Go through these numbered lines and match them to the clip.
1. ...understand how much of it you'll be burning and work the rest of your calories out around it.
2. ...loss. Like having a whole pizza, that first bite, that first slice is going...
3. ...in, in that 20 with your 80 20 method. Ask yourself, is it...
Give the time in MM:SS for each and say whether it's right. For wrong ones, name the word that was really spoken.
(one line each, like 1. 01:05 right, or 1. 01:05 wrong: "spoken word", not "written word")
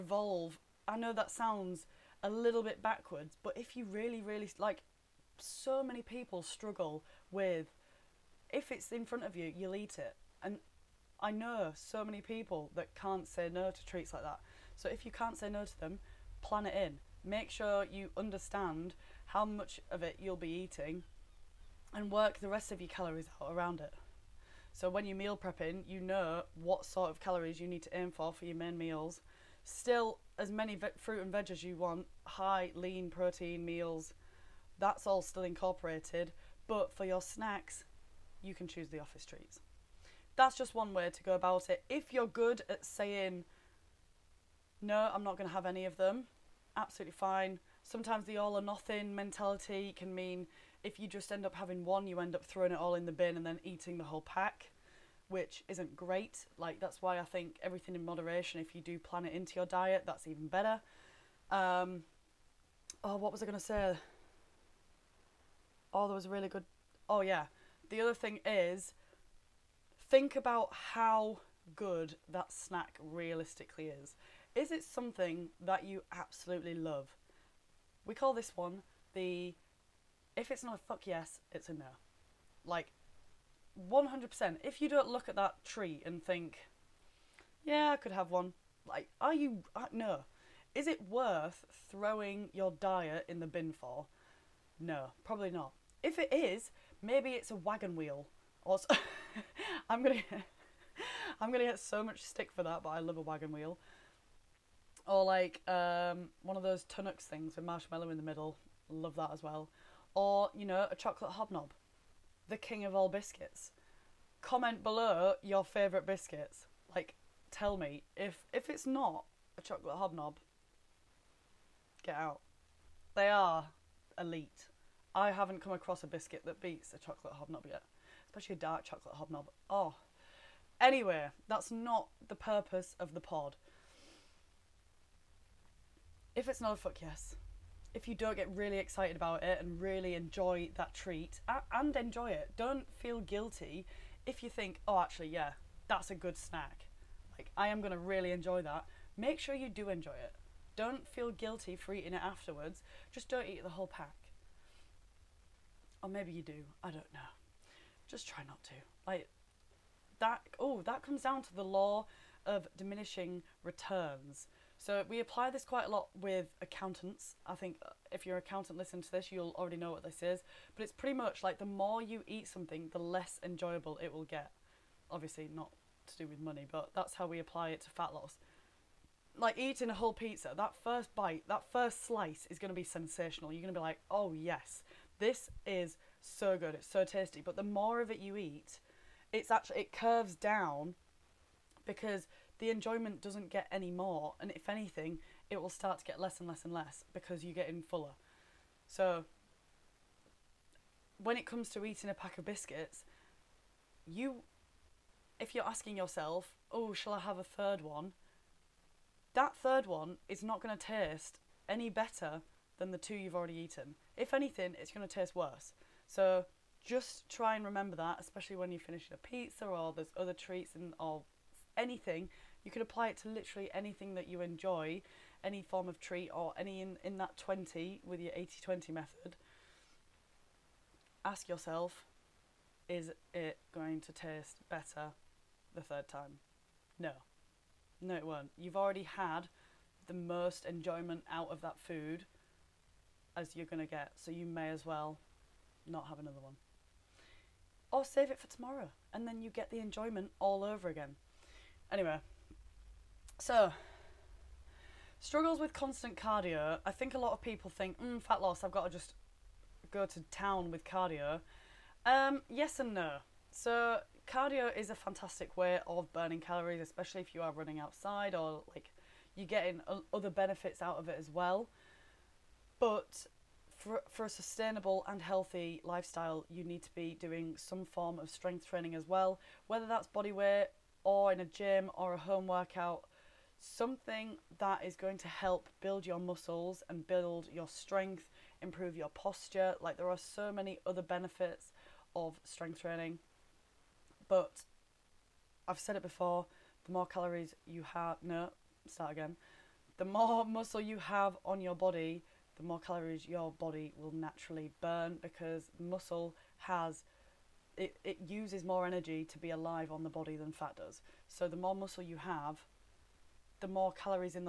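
1. 00:18 wrong: "eating", not "burning"
2. 02:58 wrong: "eating", not "having"
3. 03:46 right.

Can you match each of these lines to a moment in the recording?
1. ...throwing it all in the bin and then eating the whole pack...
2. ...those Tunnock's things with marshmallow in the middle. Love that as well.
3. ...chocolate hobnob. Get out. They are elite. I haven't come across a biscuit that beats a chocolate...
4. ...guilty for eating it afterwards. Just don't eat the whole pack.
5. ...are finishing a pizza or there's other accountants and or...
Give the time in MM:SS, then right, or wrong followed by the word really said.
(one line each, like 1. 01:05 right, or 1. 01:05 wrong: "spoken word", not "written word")
1. 00:52 right
2. 01:46 right
3. 01:59 right
4. 02:31 right
5. 03:38 wrong: "treats", not "accountants".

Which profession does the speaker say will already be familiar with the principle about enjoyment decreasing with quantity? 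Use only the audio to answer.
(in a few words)
Accountants.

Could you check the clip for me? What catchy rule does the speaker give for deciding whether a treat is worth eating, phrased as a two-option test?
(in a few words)
If it's not a fuck yes, it's a no.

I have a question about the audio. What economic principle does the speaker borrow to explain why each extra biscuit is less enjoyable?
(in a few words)
Law of diminishing returns.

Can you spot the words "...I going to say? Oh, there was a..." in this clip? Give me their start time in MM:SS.
01:03.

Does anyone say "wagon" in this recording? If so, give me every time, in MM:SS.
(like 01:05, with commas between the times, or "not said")
01:37, 01:43.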